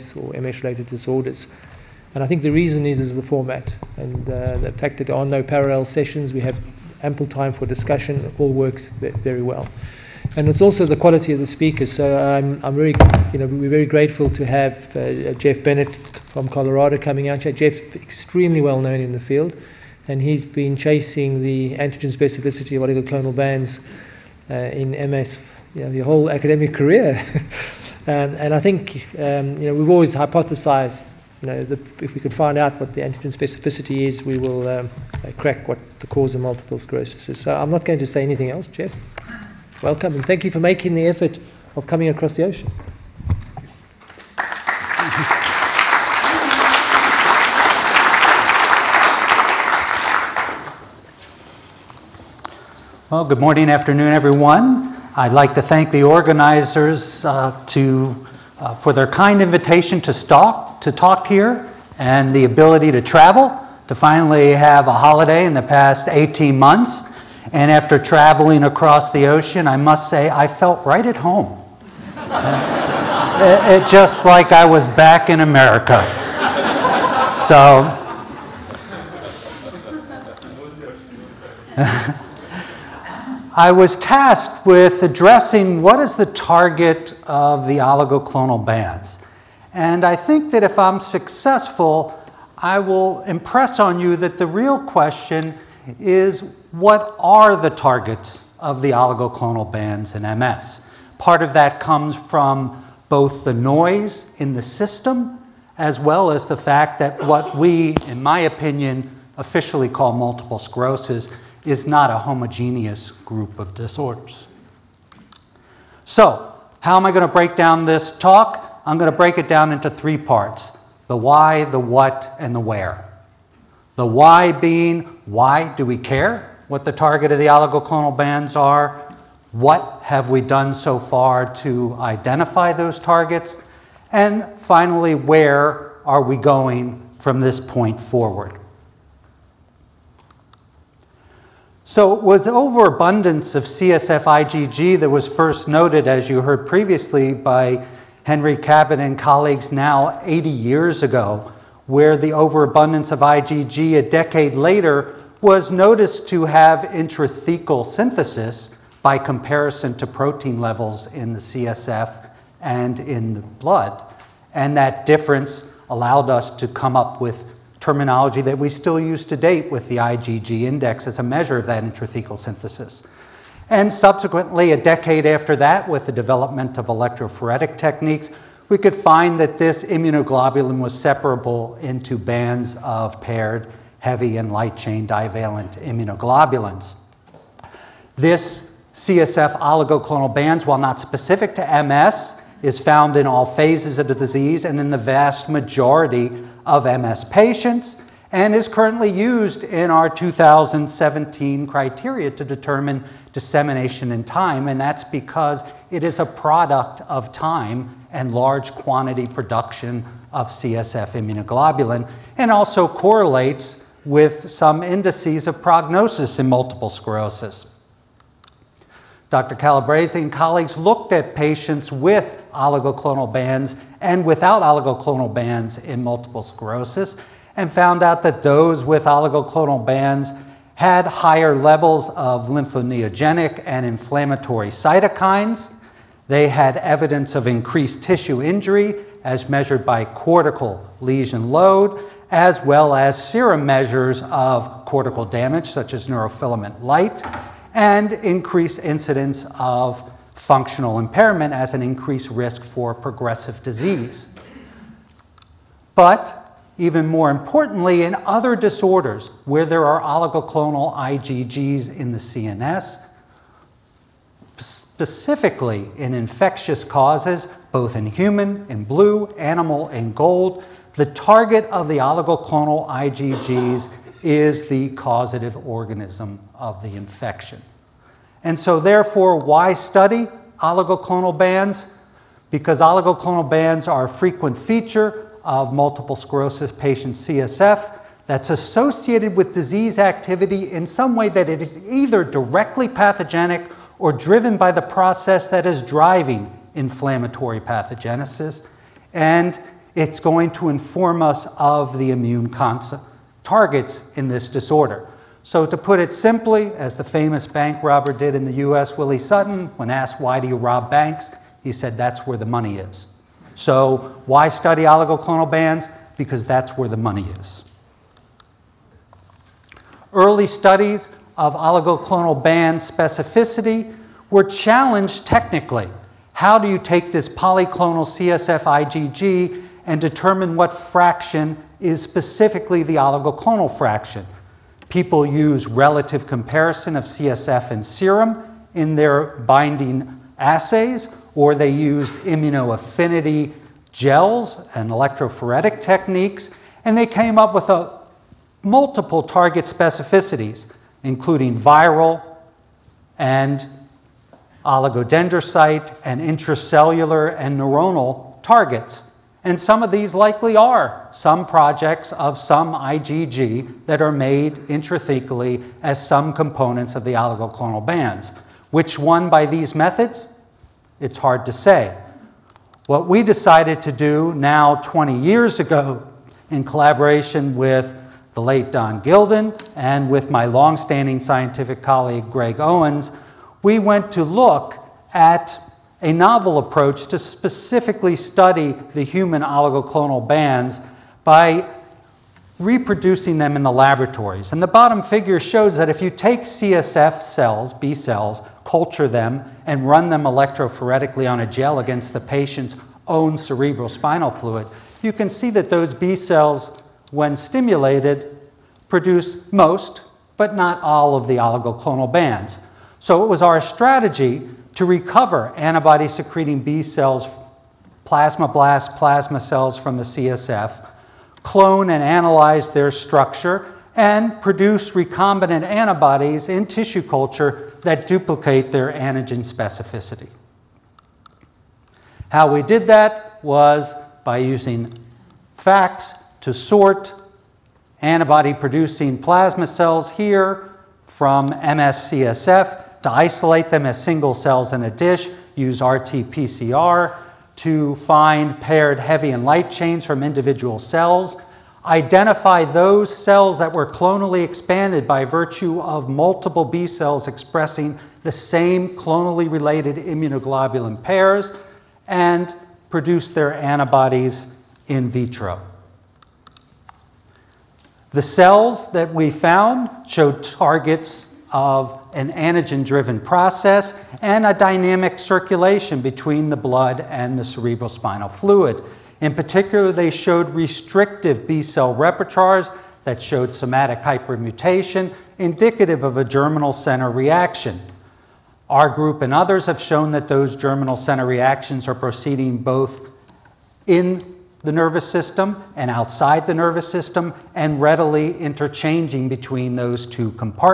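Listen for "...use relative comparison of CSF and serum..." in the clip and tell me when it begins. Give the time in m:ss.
5:35.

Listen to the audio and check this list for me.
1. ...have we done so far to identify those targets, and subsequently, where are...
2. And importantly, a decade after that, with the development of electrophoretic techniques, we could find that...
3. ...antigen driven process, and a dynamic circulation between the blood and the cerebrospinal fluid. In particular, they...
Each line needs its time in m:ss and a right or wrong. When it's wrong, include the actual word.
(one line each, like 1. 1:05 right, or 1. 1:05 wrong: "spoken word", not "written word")
1. 2:10 wrong: "finally", not "subsequently"
2. 2:53 wrong: "subsequently", not "importantly"
3. 7:52 right.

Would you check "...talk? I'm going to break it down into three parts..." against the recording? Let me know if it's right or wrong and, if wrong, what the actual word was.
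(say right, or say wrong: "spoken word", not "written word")
right.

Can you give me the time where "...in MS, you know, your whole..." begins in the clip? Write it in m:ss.
0:24.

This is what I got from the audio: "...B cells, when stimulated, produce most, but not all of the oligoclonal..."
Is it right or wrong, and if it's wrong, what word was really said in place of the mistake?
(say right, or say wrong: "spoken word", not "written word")
right.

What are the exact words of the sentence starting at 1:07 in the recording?
And after traveling across the ocean, I must say I felt right at home.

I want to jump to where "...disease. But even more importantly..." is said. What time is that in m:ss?
4:13.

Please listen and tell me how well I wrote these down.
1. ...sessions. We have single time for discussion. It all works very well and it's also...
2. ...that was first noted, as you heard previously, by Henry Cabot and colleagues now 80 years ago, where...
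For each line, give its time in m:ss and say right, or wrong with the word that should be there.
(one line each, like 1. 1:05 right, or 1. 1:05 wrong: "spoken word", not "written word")
1. 0:05 wrong: "ample", not "single"
2. 2:24 right.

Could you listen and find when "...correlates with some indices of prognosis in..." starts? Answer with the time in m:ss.
3:32.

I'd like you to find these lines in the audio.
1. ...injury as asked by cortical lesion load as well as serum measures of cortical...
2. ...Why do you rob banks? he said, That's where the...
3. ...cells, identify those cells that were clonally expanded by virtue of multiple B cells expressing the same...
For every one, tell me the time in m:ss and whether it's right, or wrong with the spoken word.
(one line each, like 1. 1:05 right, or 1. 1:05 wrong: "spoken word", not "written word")
1. 3:58 wrong: "measured", not "asked"
2. 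5:10 right
3. 7:30 right.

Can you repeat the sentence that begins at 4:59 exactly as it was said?
And it's going to inform us of the immune targets in this disorder.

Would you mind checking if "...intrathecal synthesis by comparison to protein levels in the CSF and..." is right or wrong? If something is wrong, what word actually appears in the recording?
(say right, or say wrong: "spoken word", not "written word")
right.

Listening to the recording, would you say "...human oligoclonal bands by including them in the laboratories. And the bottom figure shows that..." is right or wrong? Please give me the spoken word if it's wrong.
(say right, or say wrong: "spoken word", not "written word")
wrong: "reproducing", not "including".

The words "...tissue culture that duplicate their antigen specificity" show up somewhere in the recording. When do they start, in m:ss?
7:06.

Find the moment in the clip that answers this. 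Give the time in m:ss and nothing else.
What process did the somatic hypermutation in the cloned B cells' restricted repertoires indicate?
8:06.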